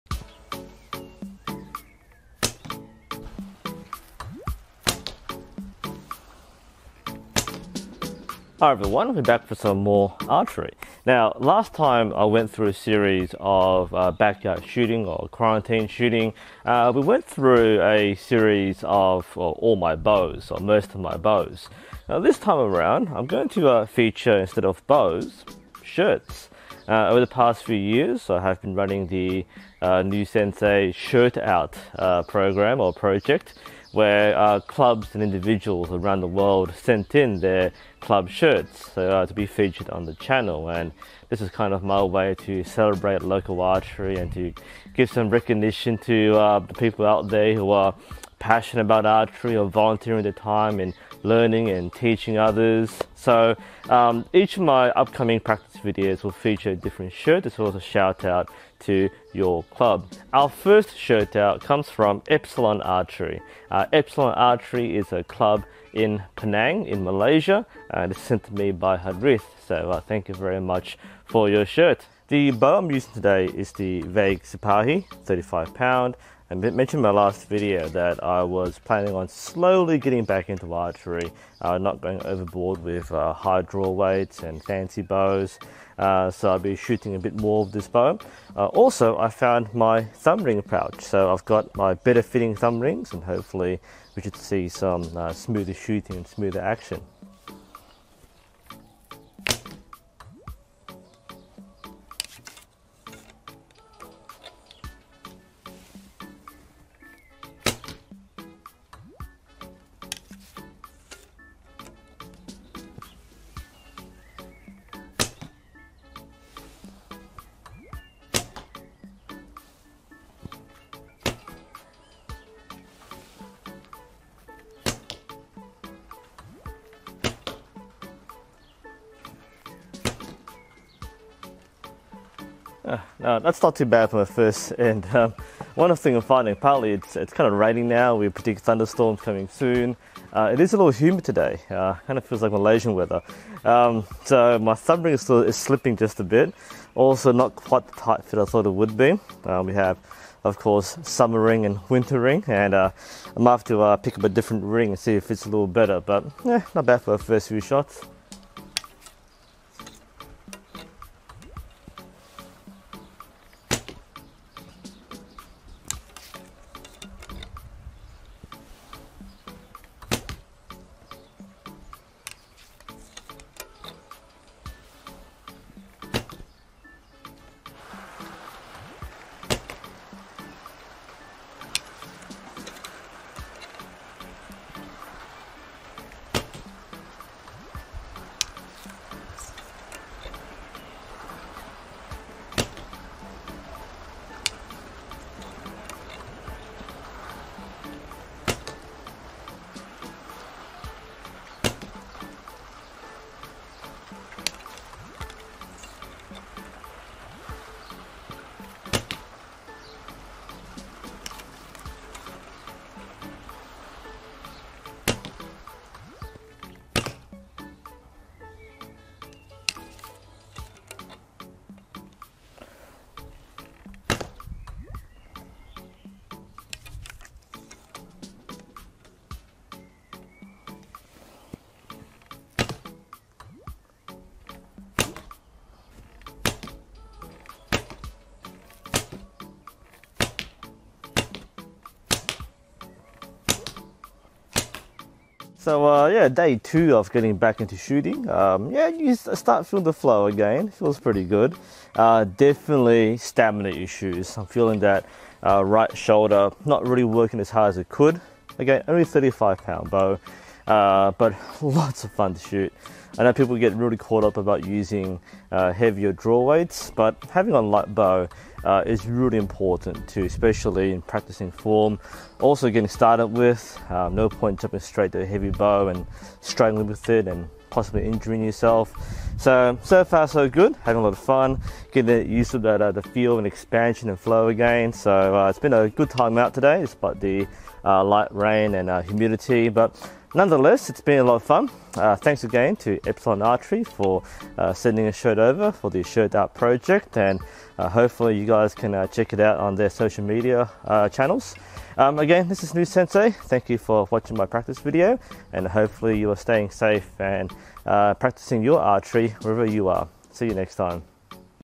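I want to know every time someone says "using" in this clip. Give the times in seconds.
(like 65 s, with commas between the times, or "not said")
72 s, 264 s.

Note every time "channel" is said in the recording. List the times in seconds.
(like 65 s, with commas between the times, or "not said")
40 s, 301 s.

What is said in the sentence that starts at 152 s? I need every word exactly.
And uh, I might have to pick up a different ring and see if it's a little better.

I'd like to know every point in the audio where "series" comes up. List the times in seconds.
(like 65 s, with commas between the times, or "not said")
12 s, 18 s.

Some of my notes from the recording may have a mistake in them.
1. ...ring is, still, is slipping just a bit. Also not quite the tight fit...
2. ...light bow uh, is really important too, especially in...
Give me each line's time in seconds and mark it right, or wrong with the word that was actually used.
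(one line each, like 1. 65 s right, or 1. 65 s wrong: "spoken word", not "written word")
1. 145 s right
2. 267 s right.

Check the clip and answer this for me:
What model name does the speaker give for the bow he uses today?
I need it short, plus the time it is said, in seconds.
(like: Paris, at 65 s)
Vague Sipahi, at 74 s.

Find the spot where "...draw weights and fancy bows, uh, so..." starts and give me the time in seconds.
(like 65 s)
83 s.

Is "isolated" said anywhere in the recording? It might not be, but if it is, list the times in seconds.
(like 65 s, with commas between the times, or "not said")
not said.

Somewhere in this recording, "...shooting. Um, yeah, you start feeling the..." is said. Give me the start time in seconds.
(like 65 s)
247 s.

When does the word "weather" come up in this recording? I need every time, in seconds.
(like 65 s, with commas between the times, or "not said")
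142 s.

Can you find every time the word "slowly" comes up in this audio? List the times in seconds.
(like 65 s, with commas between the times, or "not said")
79 s.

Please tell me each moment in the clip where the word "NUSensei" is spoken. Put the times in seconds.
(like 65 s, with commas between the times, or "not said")
30 s, 302 s.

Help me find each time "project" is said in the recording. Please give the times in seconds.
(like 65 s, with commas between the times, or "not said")
32 s, 296 s.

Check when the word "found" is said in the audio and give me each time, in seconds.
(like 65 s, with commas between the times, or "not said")
89 s.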